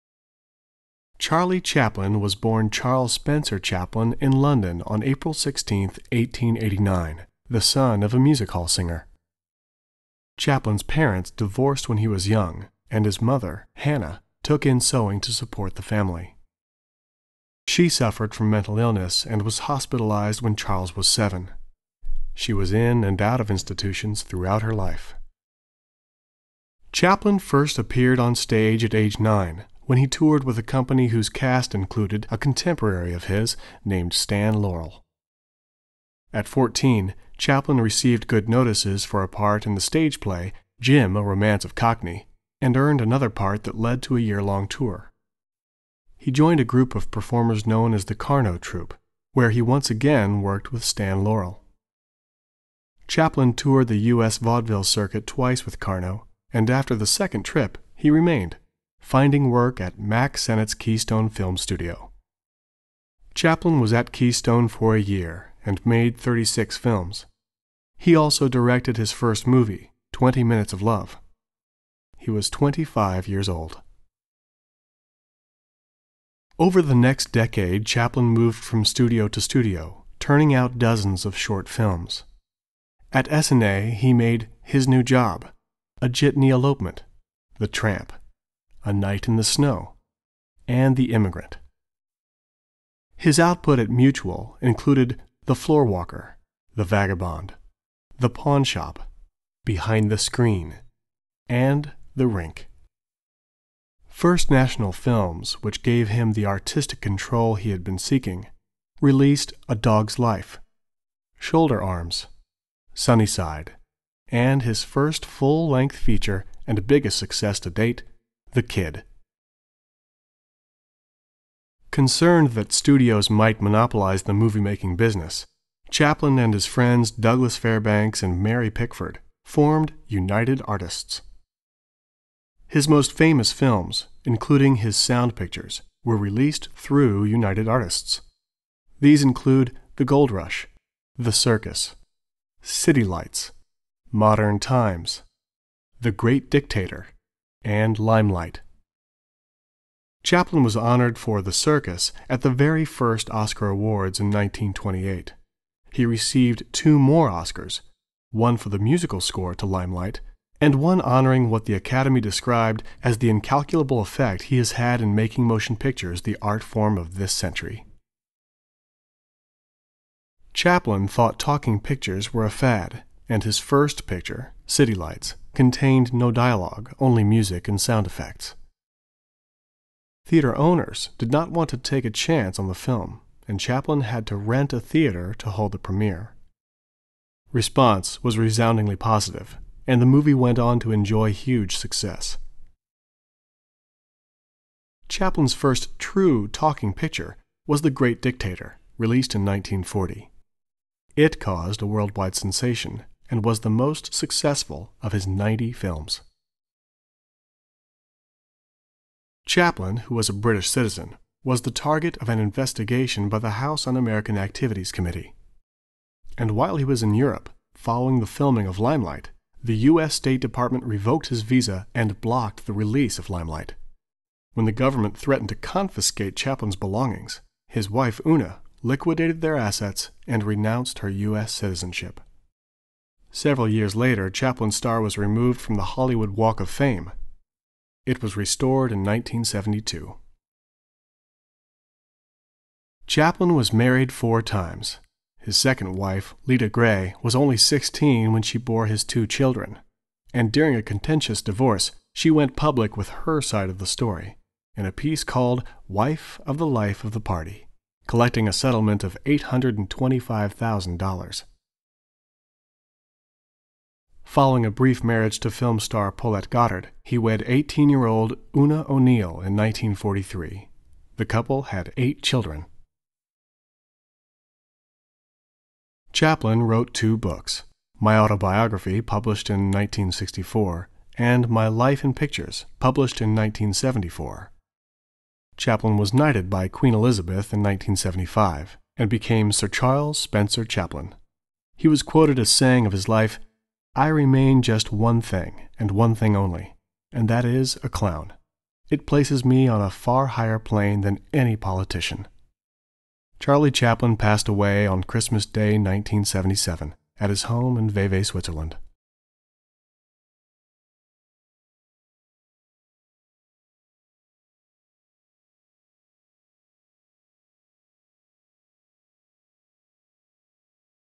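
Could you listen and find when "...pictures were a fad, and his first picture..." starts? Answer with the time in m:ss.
2:51.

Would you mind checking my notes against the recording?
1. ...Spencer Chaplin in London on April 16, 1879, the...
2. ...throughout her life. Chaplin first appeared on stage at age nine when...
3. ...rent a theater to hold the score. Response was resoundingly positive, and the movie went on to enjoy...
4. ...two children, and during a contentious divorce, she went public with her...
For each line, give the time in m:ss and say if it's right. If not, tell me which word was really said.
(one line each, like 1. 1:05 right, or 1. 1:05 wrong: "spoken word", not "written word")
1. 0:03 wrong: "1889", not "1879"
2. 0:24 right
3. 3:04 wrong: "premiere", not "score"
4. 4:09 right.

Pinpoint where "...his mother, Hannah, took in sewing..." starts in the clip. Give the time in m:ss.
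0:13.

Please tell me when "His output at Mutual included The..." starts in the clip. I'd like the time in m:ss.
1:33.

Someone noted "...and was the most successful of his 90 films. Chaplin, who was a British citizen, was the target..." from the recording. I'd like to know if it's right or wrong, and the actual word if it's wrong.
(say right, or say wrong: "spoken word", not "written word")
right.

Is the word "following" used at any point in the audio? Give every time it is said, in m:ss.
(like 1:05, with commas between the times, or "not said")
3:37, 4:24.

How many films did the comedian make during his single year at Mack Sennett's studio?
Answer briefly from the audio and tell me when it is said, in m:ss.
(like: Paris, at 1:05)
36, at 1:06.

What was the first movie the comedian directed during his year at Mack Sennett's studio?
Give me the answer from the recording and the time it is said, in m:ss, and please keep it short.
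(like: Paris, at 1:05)
20 Minutes of Love, at 1:10.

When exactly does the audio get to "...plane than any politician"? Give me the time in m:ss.
5:00.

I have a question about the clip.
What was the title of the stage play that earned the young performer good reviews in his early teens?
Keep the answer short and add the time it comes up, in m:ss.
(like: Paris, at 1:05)
Jim, A Romance of Cockayne, at 0:40.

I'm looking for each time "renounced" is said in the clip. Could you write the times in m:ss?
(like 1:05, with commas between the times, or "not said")
3:50.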